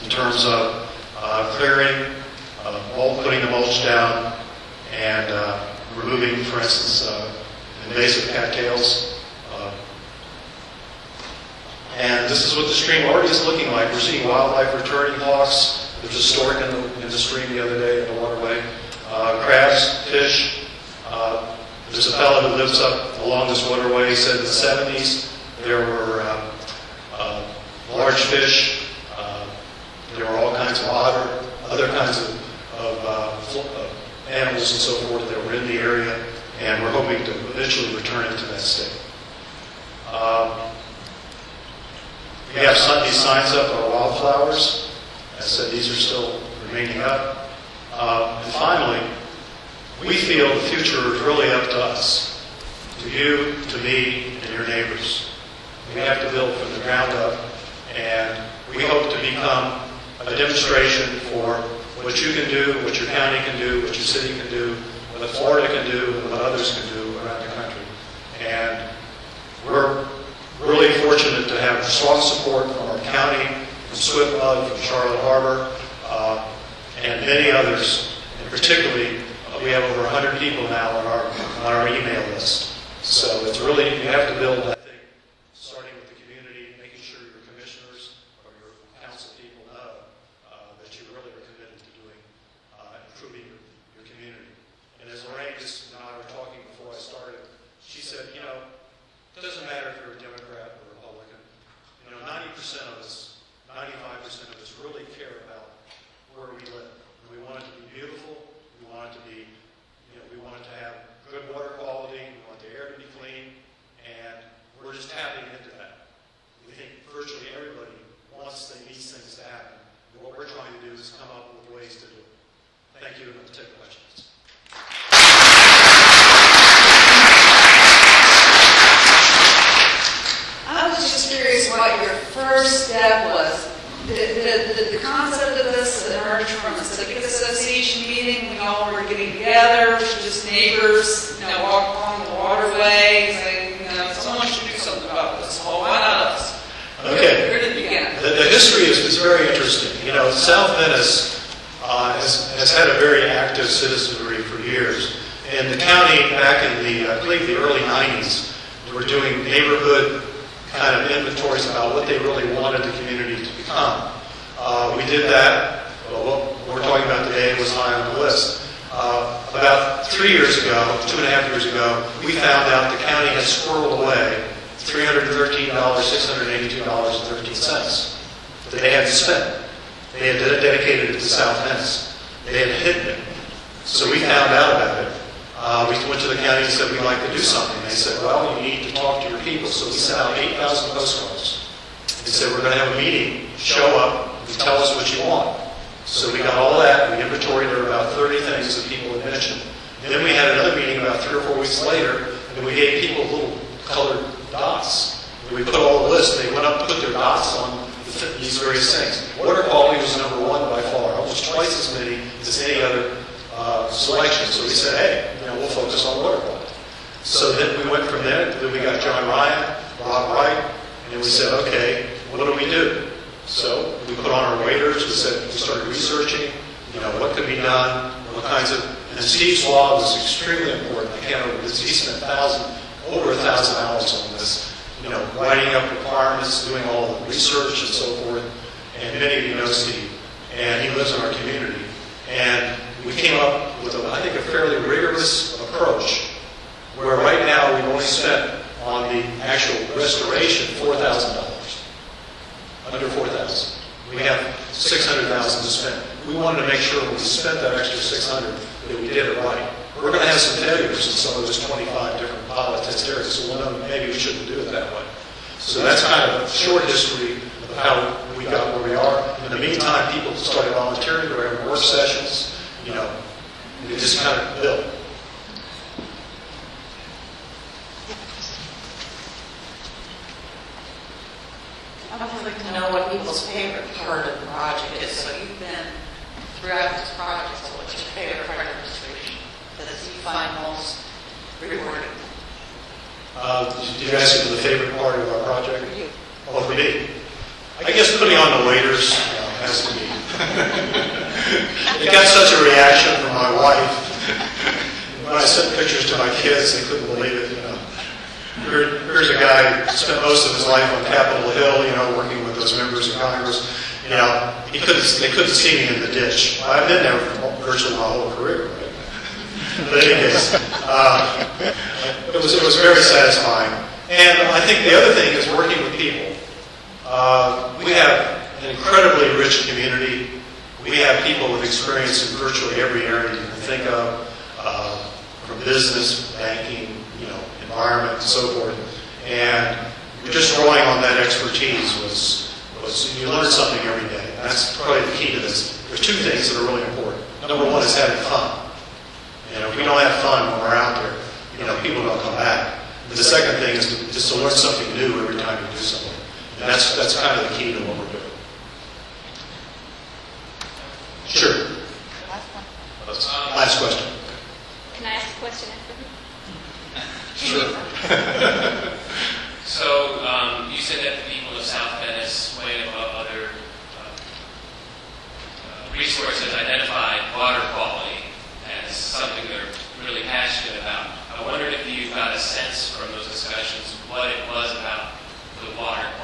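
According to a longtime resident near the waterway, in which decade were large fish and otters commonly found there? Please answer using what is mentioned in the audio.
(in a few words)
1970s.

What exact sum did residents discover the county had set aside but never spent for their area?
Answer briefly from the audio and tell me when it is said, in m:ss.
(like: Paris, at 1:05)
$313,682.13, at 2:54.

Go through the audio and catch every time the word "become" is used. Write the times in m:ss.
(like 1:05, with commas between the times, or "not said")
0:59, 2:43.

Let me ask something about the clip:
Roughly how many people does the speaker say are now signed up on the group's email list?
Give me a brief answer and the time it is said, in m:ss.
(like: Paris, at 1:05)
over 100, at 1:19.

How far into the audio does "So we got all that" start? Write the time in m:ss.
3:16.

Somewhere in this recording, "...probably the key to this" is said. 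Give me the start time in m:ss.
5:44.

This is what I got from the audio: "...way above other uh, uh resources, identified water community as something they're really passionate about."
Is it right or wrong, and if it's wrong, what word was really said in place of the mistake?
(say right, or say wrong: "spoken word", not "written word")
wrong: "quality", not "community".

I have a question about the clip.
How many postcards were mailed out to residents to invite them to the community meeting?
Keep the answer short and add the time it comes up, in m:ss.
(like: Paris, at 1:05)
8,000, at 3:10.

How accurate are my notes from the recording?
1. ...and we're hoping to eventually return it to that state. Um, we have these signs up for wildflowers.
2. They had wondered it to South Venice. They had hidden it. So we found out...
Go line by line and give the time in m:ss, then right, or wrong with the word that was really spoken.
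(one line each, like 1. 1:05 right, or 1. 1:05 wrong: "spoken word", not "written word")
1. 0:36 right
2. 3:00 wrong: "dedicated", not "wondered".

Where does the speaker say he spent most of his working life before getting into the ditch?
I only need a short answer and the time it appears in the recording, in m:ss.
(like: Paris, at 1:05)
Capitol Hill, at 5:11.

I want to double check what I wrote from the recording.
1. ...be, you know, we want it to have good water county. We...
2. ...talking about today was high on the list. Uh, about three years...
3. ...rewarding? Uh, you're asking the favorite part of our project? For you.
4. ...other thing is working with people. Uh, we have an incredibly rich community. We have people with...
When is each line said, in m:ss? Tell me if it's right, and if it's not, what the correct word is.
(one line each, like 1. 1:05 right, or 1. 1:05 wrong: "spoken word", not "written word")
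1. 1:49 wrong: "quality", not "county"
2. 2:46 right
3. 4:51 right
4. 5:24 right.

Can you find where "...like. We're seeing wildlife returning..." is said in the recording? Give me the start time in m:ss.
0:13.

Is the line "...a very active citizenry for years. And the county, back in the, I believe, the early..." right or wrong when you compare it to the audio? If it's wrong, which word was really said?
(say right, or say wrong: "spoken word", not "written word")
right.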